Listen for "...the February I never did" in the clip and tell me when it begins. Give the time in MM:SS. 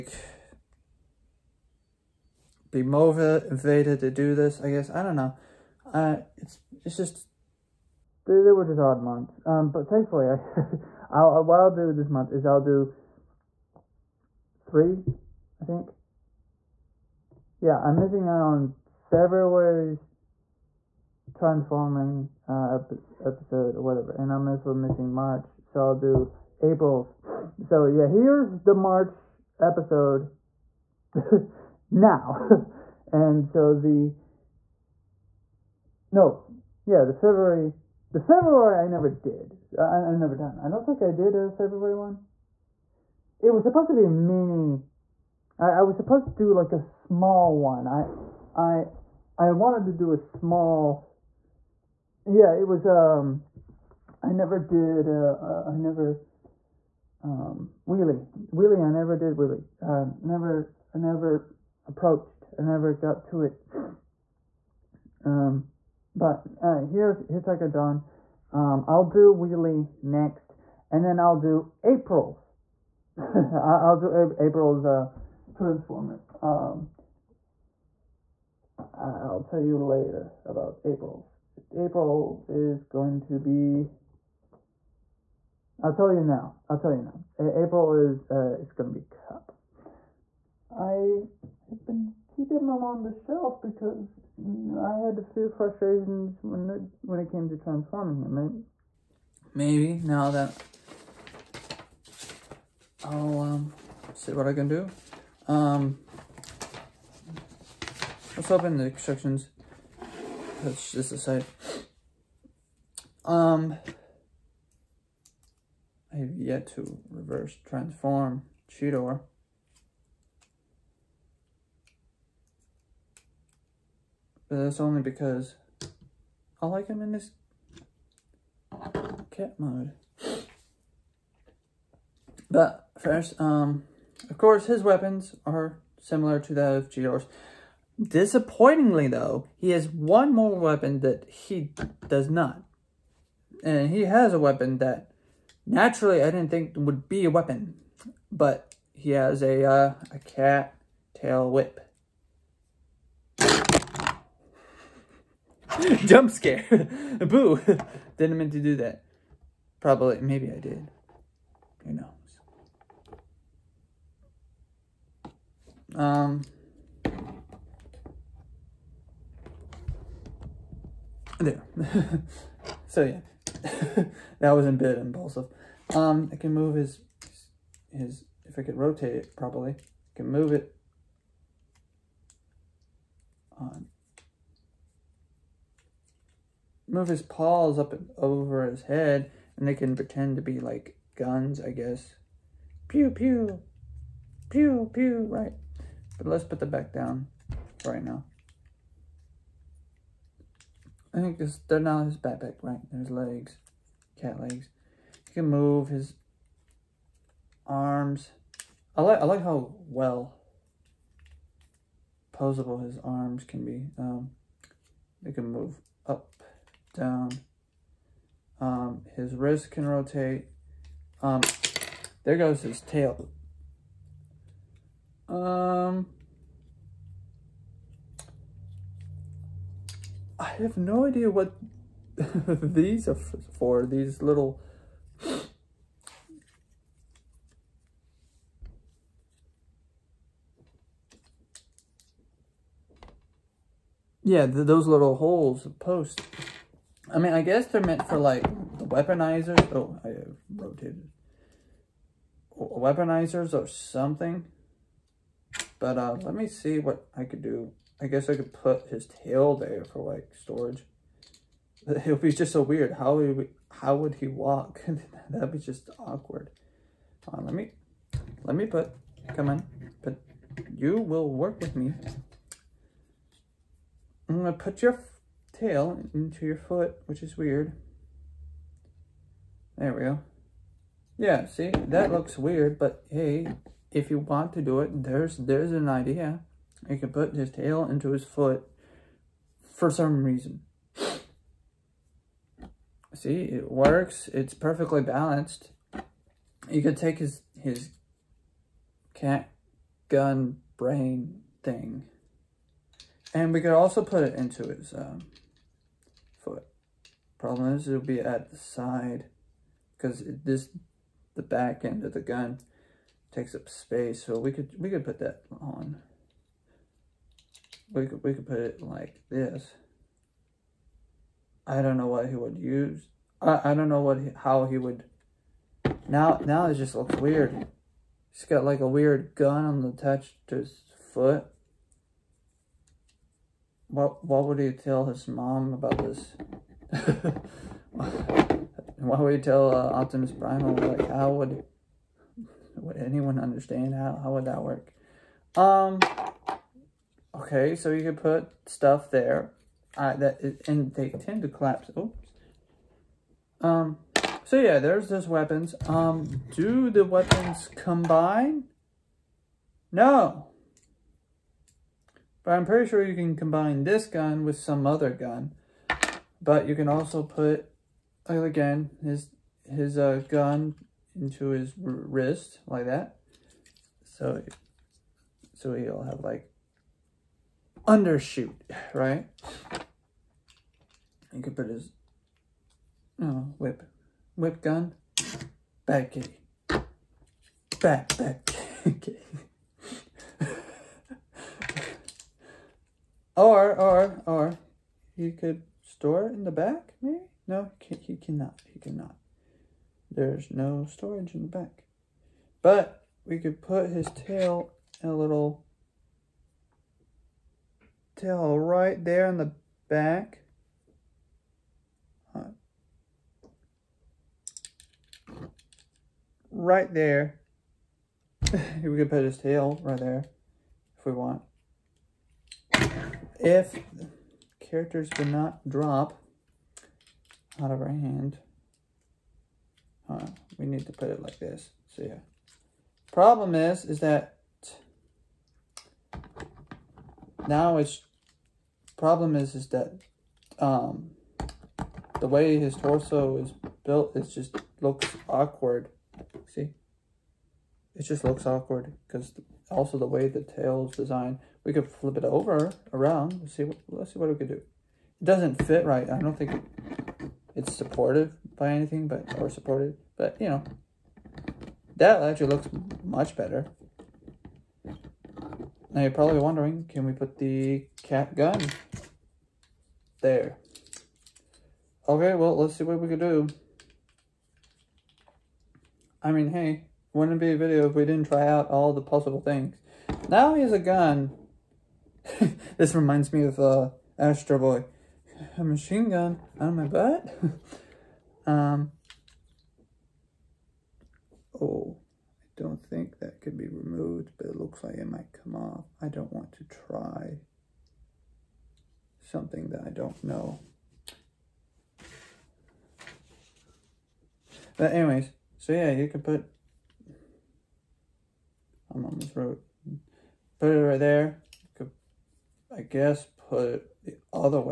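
00:38.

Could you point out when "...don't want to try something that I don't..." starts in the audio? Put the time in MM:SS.
08:16.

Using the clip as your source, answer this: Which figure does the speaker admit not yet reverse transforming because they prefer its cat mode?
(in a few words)
Cheetor.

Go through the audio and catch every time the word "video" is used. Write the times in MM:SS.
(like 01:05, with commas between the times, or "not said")
07:57.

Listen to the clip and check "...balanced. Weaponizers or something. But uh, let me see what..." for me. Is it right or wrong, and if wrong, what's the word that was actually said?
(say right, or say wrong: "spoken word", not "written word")
wrong: "rotated", not "balanced".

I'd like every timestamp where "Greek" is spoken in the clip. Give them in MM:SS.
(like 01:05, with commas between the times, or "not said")
not said.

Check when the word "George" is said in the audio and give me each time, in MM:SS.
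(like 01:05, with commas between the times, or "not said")
02:16.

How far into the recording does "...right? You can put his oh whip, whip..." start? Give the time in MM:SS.
06:18.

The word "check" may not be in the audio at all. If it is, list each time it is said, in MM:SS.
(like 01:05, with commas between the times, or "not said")
not said.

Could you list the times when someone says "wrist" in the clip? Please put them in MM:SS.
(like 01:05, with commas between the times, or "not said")
03:39, 06:11.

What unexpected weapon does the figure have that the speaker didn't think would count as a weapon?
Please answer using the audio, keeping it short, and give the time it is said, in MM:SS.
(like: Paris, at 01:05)
cat tail whip, at 02:30.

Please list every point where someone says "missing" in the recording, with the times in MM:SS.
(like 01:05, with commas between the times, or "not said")
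00:17, 00:24.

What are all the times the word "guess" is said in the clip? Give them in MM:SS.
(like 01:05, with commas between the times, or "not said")
00:04, 03:11, 04:07, 04:18, 08:32.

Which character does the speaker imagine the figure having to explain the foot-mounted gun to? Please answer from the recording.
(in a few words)
Optimus Primal.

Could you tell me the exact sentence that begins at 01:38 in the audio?
Maybe, maybe now that I'll um, see what I can do.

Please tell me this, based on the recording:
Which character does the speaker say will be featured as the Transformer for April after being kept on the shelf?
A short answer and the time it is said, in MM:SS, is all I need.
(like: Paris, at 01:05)
Kup, at 01:29.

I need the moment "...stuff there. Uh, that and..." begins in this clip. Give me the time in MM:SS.
05:48.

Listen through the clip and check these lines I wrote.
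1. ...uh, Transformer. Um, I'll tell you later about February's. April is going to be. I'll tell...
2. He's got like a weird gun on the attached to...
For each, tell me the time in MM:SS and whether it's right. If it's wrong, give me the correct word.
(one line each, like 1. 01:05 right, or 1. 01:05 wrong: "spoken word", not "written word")
1. 01:14 wrong: "April", not "February"
2. 05:28 right.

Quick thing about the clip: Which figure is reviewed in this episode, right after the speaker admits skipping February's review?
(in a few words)
Tigertron.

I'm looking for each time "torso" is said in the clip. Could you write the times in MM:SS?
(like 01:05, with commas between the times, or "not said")
07:22.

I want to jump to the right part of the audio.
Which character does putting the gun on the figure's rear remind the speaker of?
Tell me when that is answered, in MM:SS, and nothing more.
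08:04.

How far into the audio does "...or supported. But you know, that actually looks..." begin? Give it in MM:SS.
07:39.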